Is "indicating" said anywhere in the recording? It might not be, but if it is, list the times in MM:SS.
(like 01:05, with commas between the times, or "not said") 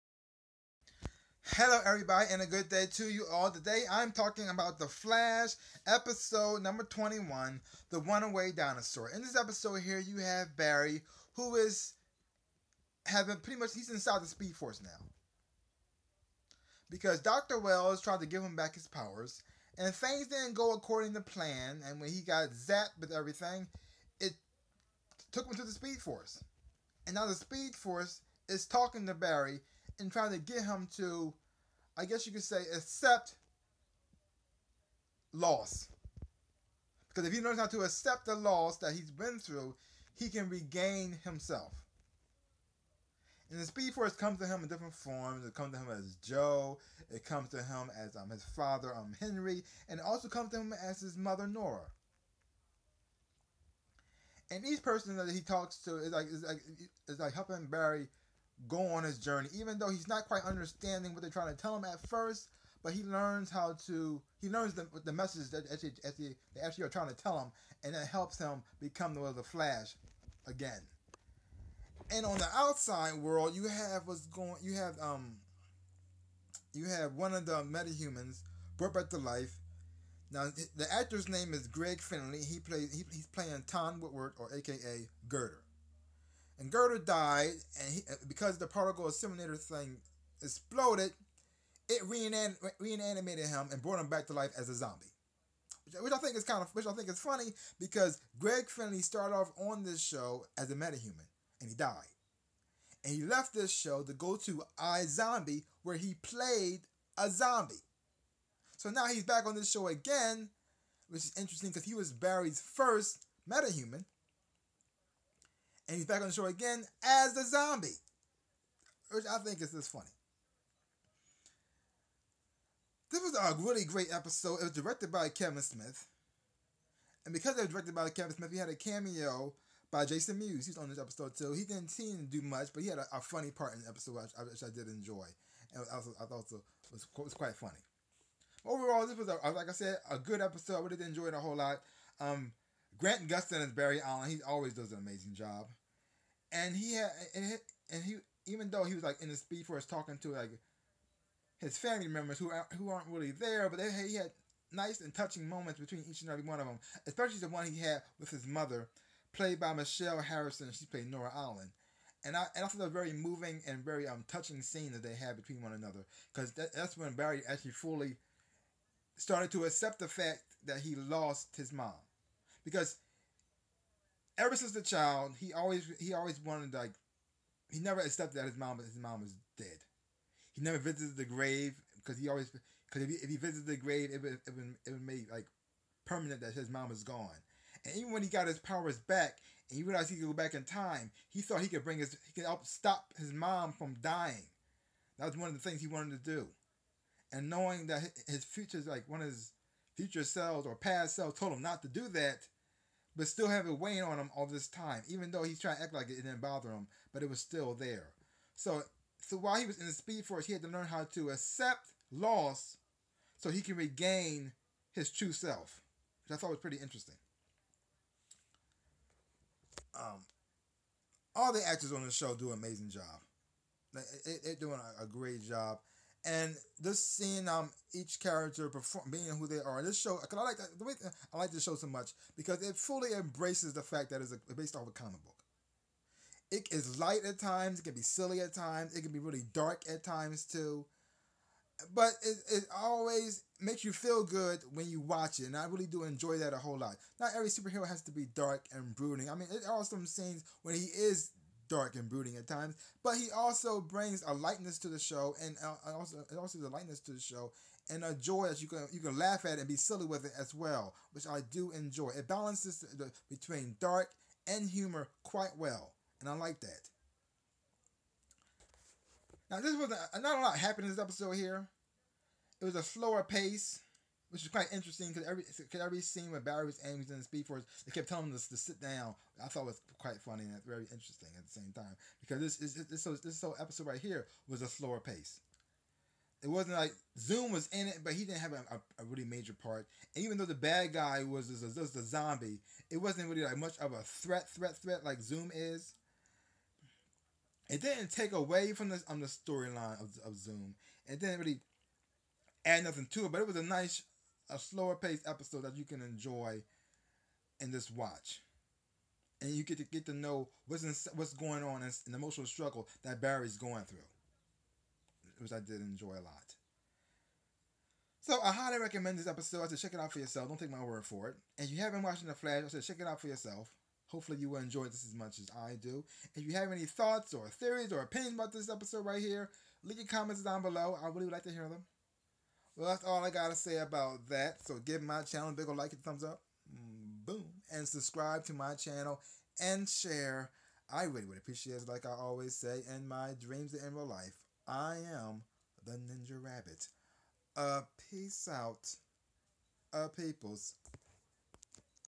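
not said.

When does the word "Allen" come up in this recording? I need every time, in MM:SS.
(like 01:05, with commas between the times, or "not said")
02:24, 02:41.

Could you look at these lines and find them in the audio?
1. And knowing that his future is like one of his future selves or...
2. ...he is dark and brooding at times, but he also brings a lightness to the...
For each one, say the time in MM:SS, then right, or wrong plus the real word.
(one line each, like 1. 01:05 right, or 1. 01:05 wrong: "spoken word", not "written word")
1. 03:17 right
2. 04:10 right.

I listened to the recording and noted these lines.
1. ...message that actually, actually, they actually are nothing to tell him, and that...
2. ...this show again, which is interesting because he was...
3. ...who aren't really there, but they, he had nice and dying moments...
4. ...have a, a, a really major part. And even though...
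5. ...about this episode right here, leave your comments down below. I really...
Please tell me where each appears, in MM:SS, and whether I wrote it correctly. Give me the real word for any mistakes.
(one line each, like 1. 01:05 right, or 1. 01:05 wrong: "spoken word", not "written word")
1. 01:05 wrong: "trying", not "nothing"
2. 01:49 right
3. 02:32 wrong: "touching", not "dying"
4. 04:48 right
5. 05:28 right.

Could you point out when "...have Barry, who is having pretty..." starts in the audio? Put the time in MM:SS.
00:10.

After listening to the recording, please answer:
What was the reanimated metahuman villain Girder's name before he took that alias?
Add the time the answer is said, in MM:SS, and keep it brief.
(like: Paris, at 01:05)
Tom Woodward, at 01:23.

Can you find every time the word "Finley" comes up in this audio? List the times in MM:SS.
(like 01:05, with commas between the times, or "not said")
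01:22, 01:38.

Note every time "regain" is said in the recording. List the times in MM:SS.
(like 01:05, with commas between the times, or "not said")
00:40, 03:33.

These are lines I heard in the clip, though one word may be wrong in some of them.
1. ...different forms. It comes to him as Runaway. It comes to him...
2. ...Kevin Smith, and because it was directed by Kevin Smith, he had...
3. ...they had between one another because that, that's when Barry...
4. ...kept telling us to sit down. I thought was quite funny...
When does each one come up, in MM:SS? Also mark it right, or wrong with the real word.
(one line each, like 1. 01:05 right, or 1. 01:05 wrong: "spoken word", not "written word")
1. 00:44 wrong: "Joe", not "Runaway"
2. 02:05 right
3. 02:45 right
4. 04:37 right.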